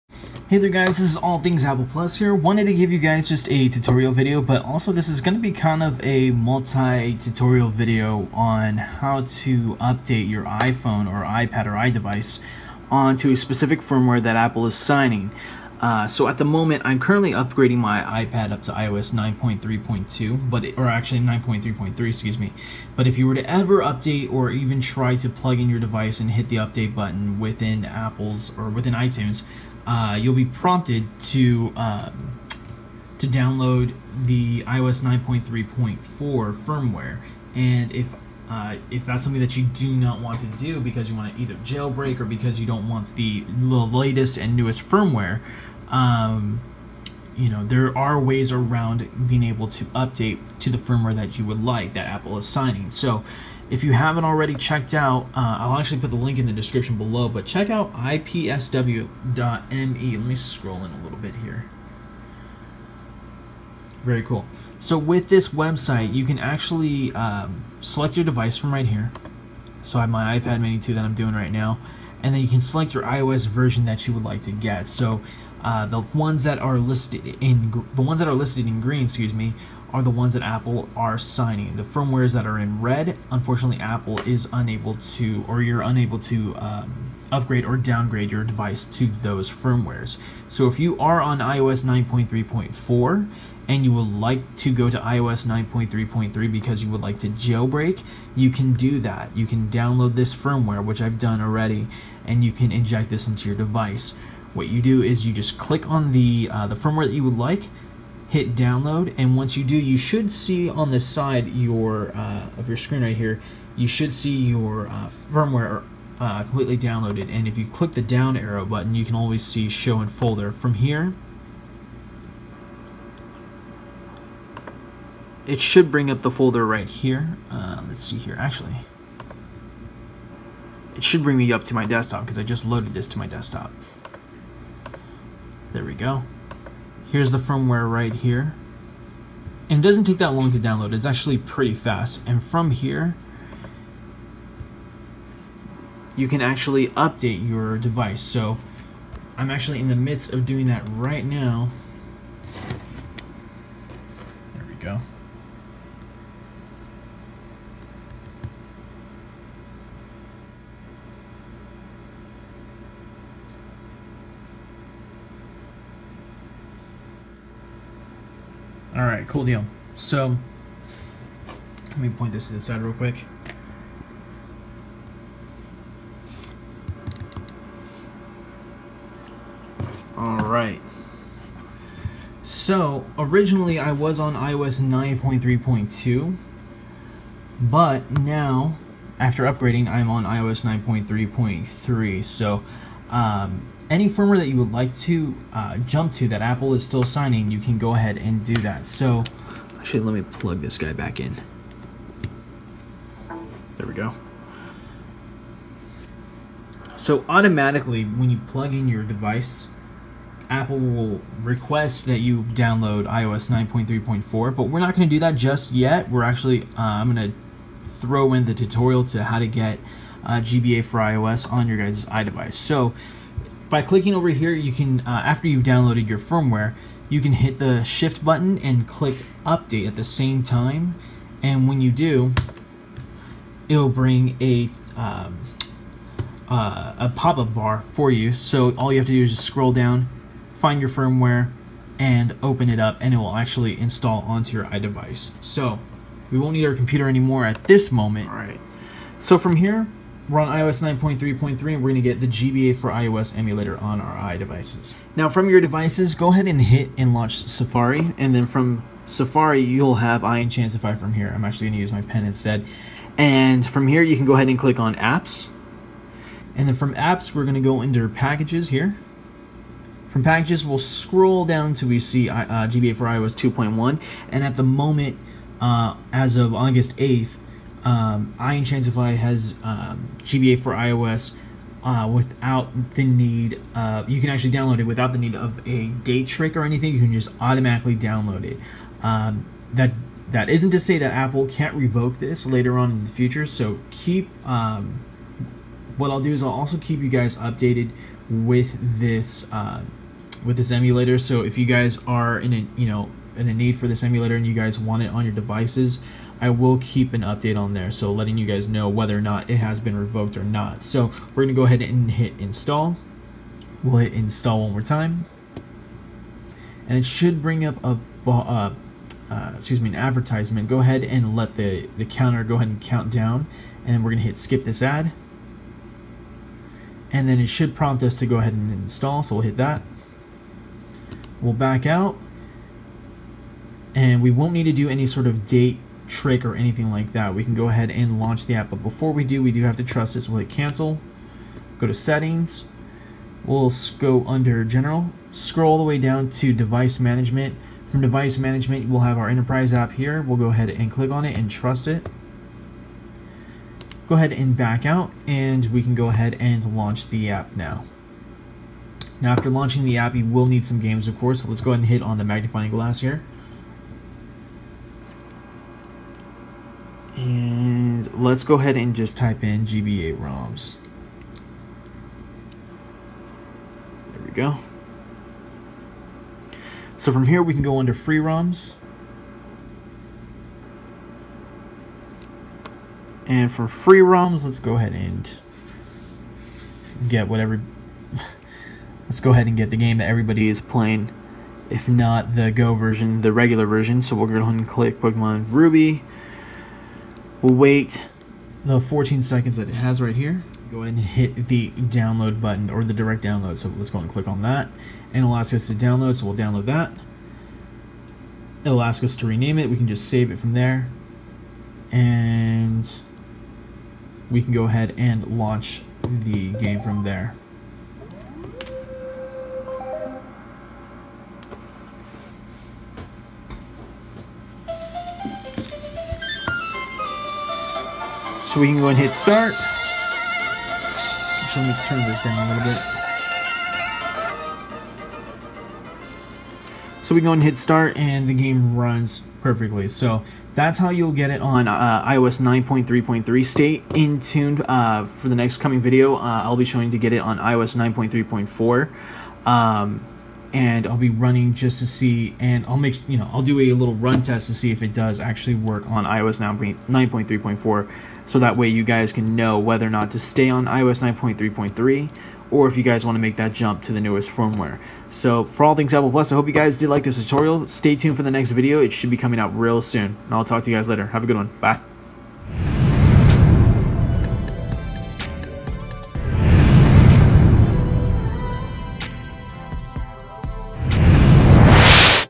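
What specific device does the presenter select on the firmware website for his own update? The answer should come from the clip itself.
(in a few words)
iPad Mini 2.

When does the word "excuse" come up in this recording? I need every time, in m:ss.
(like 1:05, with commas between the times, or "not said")
0:22, 1:19, 5:19.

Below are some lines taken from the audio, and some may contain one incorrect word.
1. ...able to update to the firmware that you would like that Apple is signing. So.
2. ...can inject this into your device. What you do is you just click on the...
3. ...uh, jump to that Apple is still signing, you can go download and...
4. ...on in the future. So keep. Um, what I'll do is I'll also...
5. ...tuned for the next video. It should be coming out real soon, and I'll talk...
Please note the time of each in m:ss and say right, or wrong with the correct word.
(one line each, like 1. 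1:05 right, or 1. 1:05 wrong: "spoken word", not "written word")
1. 0:49 right
2. 1:42 right
3. 3:15 wrong: "ahead", not "download"
4. 4:52 right
5. 7:47 right.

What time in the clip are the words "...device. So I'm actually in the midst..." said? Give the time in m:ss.
2:27.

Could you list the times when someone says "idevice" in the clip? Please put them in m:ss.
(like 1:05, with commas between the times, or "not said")
0:11, 3:42, 4:04, 4:14.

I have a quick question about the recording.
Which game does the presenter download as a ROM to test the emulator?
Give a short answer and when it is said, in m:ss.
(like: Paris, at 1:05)
Pokemon Ruby, at 6:34.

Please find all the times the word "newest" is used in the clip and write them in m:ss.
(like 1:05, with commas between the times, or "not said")
0:44, 7:44.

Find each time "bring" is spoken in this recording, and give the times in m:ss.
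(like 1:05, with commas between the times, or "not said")
2:05, 2:11, 3:53, 5:17.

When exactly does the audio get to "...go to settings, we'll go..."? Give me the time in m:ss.
5:41.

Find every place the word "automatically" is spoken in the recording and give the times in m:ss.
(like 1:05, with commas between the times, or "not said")
3:27, 4:47.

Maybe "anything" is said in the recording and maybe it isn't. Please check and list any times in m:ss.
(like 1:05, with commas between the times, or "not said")
4:46, 5:36.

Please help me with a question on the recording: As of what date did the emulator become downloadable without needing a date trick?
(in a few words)
August 8th.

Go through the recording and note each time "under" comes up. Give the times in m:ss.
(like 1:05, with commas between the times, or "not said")
5:44, 6:17.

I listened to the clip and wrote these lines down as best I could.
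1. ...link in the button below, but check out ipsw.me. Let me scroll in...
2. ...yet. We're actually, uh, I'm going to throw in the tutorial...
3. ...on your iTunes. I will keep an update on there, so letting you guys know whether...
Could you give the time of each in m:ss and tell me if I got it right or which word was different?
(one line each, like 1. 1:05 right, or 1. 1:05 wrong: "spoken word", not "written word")
1. 0:56 wrong: "description", not "button"
2. 3:35 right
3. 5:05 wrong: "devices", not "iTunes".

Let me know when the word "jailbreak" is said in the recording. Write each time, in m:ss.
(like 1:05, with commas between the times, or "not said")
0:41, 1:37.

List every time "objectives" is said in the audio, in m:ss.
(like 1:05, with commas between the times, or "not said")
not said.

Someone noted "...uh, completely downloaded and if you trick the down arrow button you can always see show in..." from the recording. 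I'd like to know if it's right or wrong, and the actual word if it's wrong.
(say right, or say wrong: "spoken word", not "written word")
wrong: "click", not "trick".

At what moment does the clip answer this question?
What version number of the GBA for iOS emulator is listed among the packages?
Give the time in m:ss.
4:33.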